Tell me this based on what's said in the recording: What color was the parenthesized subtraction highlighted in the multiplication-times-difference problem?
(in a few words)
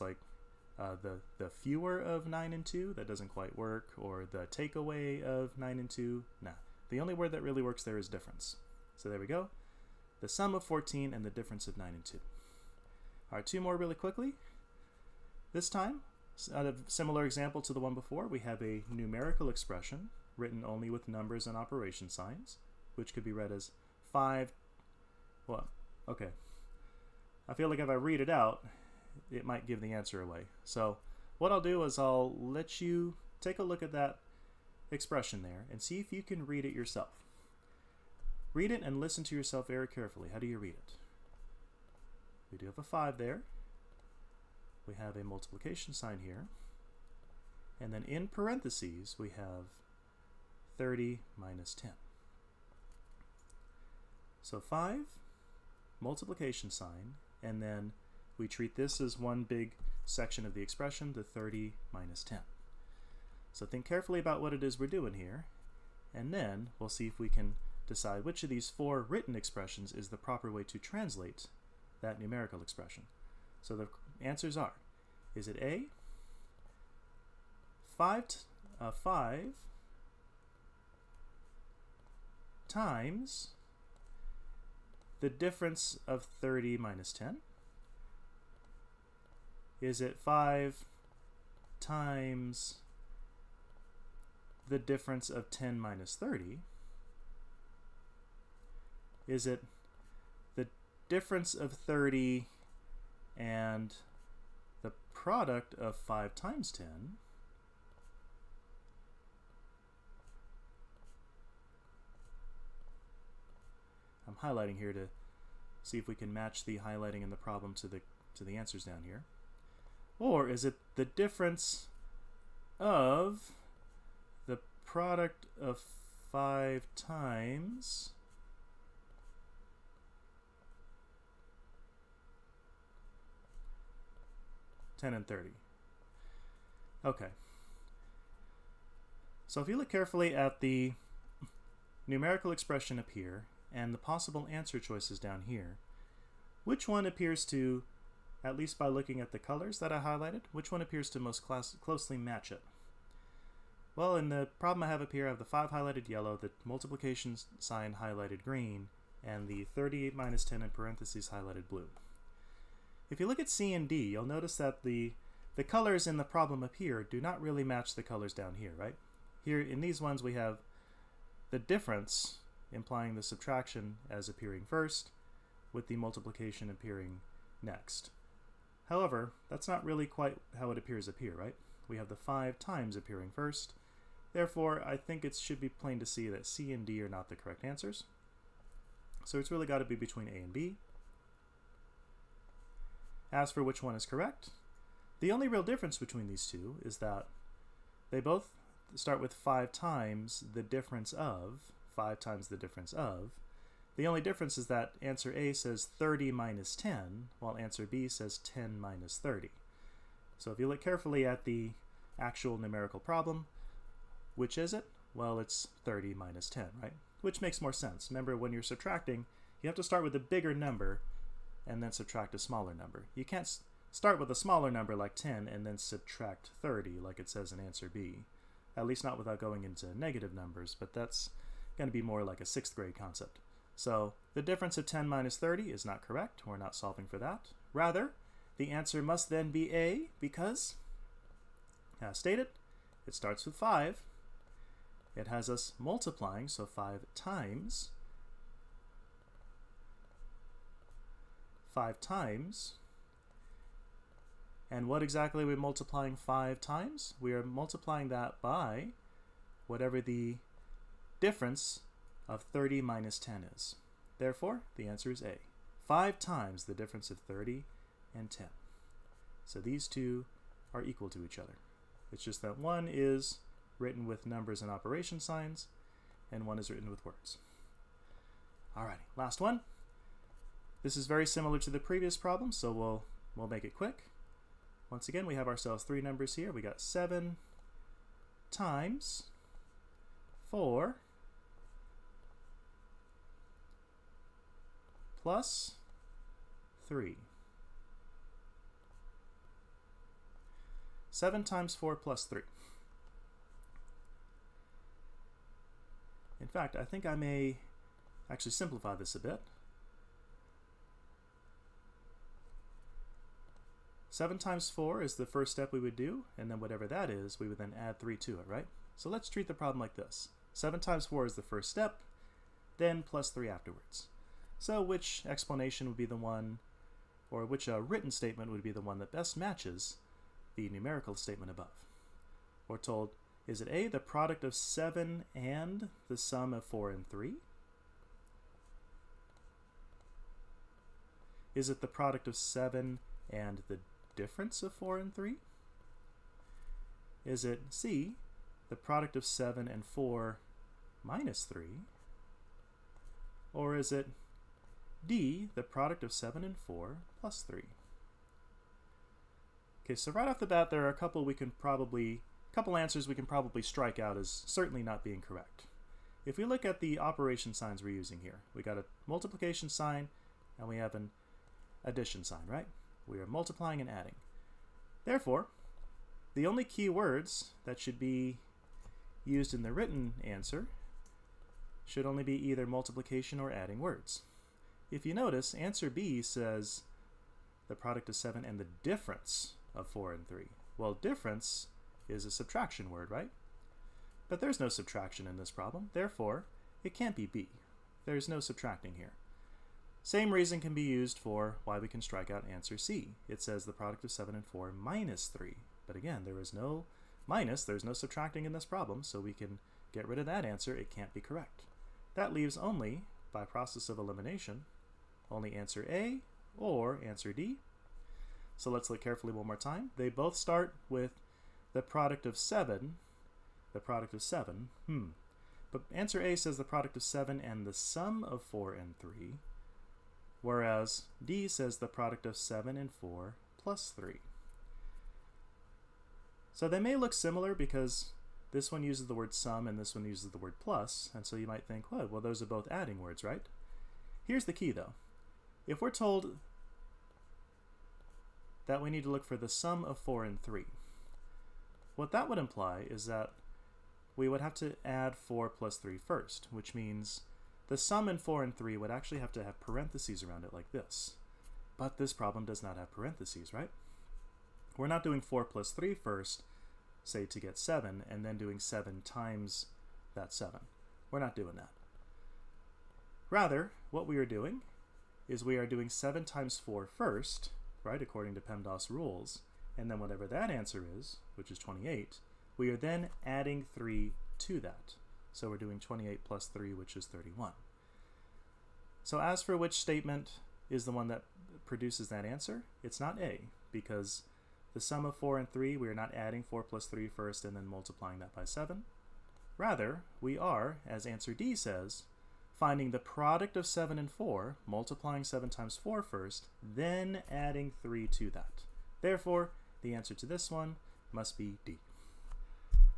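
blue.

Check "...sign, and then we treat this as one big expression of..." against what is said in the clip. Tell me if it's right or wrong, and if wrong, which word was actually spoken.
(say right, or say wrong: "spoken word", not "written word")
wrong: "section", not "expression".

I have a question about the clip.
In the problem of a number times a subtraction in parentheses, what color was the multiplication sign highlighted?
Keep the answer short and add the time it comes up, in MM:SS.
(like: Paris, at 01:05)
green, at 02:36.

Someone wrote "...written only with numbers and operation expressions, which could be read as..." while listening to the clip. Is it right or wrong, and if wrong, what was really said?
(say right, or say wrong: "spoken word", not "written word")
wrong: "signs", not "expressions".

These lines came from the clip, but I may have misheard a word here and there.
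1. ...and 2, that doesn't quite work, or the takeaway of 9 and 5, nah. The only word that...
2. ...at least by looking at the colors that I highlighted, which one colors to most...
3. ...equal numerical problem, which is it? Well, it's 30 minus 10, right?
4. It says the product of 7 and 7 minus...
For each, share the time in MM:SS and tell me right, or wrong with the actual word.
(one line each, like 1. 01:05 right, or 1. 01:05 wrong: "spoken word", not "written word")
1. 00:02 wrong: "2", not "5"
2. 02:28 wrong: "appears", not "colors"
3. 03:32 wrong: "actual", not "equal"
4. 06:43 wrong: "4", not "7".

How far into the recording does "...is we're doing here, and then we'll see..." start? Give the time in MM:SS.
01:04.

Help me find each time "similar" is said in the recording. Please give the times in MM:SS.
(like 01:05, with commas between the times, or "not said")
00:16, 04:41, 07:17.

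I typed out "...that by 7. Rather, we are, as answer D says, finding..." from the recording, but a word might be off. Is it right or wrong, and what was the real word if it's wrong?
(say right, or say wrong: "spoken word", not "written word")
right.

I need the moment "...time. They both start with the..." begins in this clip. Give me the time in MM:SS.
06:59.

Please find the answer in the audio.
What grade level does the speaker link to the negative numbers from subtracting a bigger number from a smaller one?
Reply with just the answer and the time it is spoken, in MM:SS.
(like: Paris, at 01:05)
sixth grade, at 03:52.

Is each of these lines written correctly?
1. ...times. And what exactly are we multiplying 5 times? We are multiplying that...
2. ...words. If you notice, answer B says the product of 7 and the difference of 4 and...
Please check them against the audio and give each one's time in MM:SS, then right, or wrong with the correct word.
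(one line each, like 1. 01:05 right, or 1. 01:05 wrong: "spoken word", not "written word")
1. 04:11 right
2. 06:23 right.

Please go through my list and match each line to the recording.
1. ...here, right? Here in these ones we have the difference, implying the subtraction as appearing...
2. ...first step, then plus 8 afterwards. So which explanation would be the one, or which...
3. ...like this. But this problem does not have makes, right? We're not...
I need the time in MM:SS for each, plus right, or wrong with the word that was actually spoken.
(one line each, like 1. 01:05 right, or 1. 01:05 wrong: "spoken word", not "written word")
1. 02:48 right
2. 05:21 wrong: "3", not "8"
3. 07:40 wrong: "parentheses", not "makes".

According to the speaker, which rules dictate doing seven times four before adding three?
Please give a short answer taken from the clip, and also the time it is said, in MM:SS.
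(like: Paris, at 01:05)
PEMDAS, at 07:58.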